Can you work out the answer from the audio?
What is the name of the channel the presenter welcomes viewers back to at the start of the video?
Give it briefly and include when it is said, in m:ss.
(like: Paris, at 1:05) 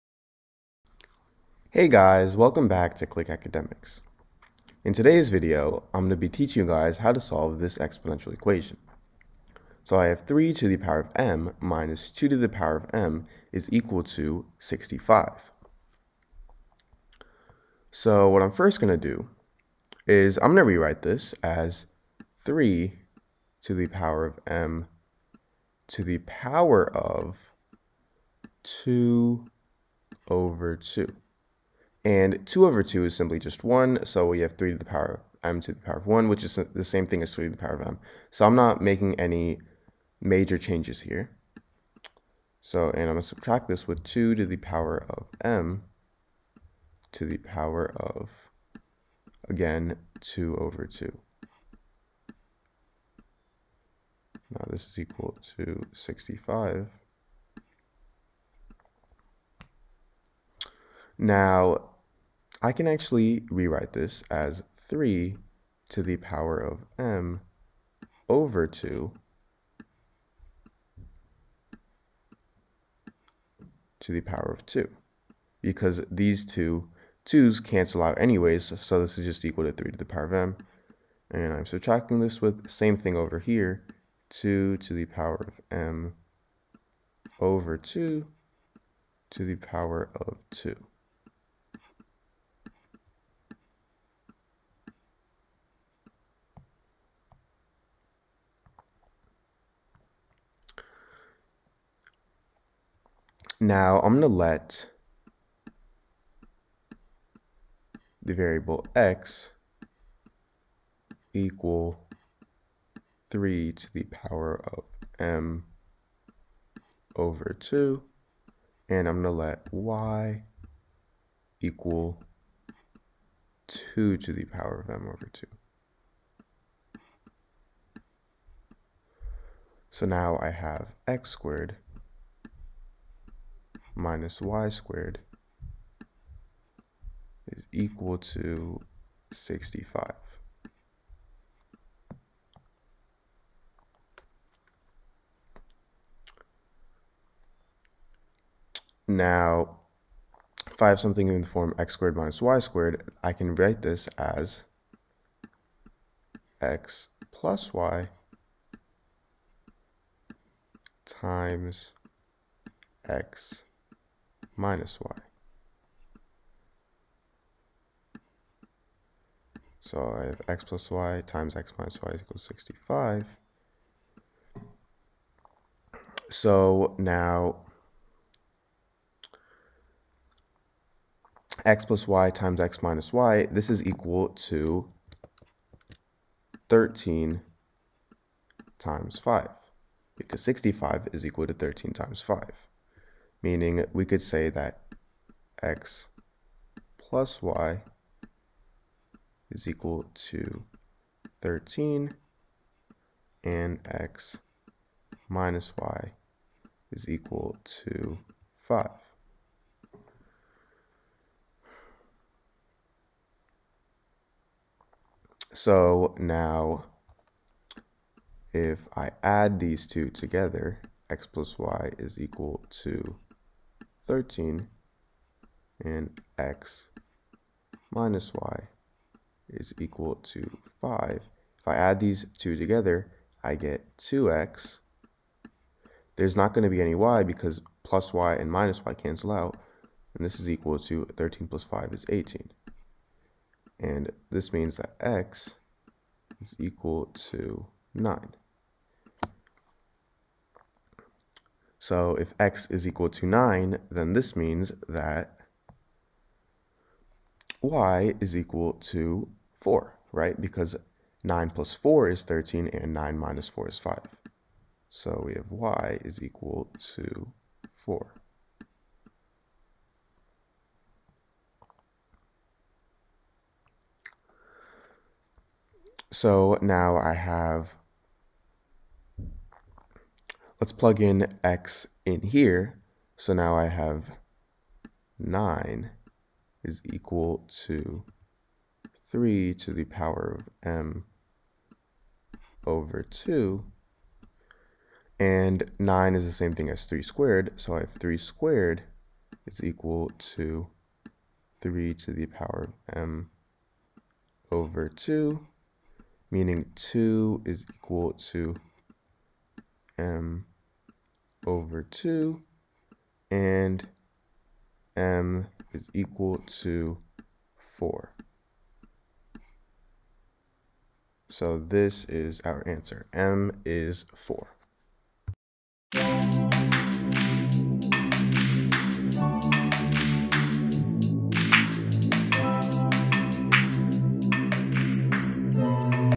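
Click Academics, at 0:03.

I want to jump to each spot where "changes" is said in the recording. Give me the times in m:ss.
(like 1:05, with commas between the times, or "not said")
0:40.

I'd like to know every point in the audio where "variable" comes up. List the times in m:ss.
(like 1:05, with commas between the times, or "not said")
1:48.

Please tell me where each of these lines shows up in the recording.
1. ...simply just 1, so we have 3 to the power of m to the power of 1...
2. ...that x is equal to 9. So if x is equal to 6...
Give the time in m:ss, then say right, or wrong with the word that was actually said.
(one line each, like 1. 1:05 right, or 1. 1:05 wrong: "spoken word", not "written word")
1. 0:33 right
2. 4:04 wrong: "9", not "6".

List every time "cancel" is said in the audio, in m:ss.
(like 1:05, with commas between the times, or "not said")
1:17, 3:58.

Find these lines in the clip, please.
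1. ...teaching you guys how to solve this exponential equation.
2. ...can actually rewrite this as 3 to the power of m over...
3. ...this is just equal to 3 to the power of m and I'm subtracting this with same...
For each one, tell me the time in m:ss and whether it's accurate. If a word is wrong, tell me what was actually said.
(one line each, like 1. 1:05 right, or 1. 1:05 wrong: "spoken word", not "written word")
1. 0:06 right
2. 1:02 right
3. 1:19 right.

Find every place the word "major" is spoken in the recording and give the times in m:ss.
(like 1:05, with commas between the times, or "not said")
0:40.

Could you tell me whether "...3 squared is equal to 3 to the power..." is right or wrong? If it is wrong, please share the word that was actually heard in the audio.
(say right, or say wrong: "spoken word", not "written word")
right.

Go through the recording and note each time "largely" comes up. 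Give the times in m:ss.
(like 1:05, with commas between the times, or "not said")
not said.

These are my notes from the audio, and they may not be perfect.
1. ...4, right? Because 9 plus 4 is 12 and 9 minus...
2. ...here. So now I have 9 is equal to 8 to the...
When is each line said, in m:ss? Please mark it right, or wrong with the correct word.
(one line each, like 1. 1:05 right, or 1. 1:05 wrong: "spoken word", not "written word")
1. 4:19 wrong: "13", not "12"
2. 4:42 wrong: "3", not "8".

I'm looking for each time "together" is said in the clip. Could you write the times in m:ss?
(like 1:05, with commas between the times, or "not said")
3:40, 3:52.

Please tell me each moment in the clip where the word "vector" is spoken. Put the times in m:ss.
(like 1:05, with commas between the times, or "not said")
not said.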